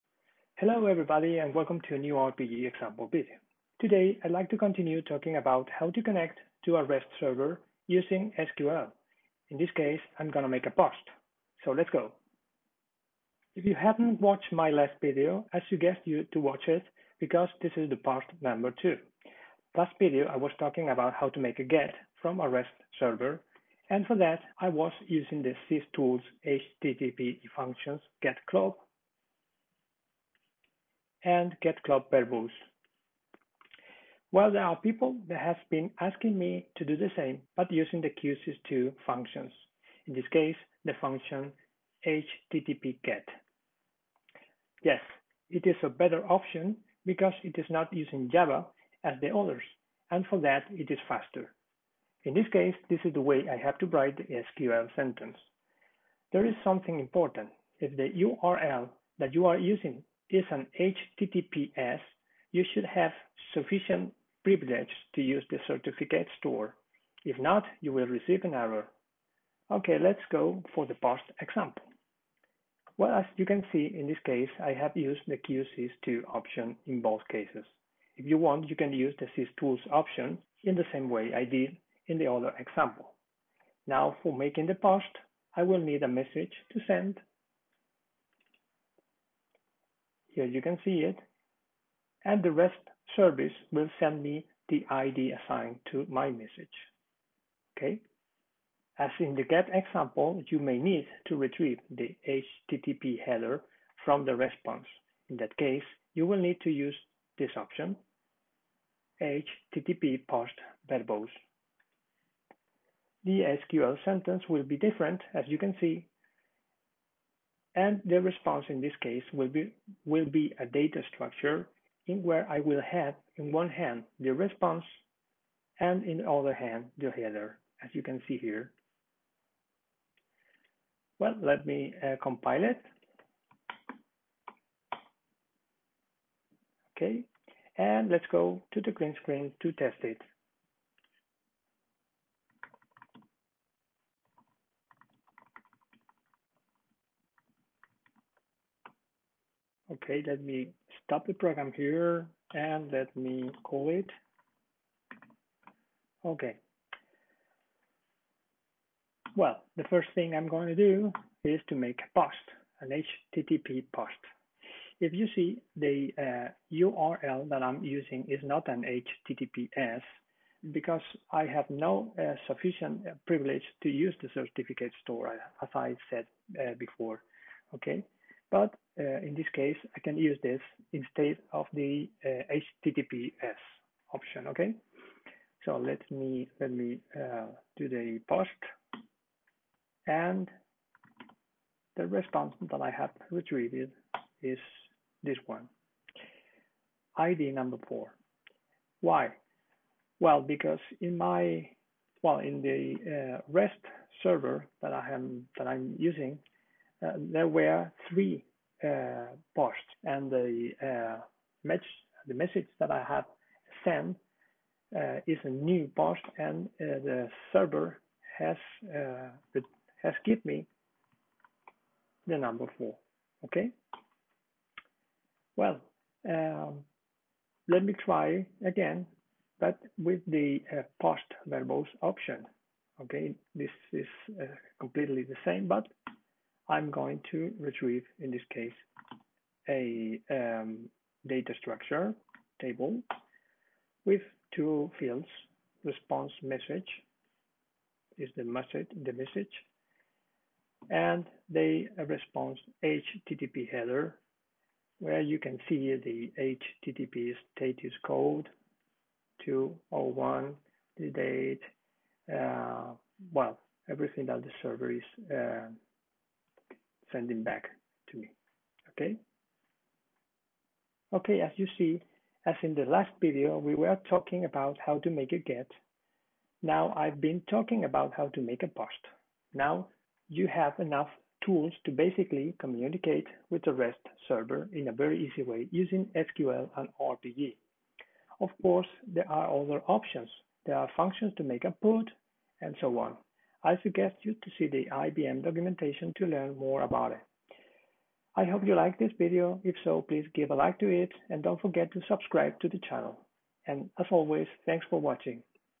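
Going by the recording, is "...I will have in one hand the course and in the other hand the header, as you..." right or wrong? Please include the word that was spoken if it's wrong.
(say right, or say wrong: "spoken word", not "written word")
wrong: "response", not "course".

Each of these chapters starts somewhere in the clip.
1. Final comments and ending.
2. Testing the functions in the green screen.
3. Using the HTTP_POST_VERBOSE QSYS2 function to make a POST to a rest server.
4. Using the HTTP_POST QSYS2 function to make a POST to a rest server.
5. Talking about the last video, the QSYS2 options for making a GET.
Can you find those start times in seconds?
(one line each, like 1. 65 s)
1. 270 s
2. 142 s
3. 99 s
4. 71 s
5. 12 s.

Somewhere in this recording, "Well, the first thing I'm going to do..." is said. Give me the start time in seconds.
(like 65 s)
159 s.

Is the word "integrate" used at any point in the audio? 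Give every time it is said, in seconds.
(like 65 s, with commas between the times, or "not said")
not said.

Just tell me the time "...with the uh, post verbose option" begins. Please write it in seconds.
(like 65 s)
229 s.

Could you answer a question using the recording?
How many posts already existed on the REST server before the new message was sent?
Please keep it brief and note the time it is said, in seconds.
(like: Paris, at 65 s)
3, at 208 s.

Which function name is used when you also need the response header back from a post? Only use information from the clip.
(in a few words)
HTTP post verbose.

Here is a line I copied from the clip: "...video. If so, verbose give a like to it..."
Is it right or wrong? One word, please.
wrong.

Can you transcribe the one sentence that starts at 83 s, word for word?
Now, for making the post, I will need a message to send here you can see it.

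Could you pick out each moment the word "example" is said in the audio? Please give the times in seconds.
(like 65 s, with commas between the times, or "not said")
2 s, 71 s, 82 s, 99 s.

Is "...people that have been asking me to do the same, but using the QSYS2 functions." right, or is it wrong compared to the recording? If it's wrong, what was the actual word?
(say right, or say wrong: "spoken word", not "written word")
right.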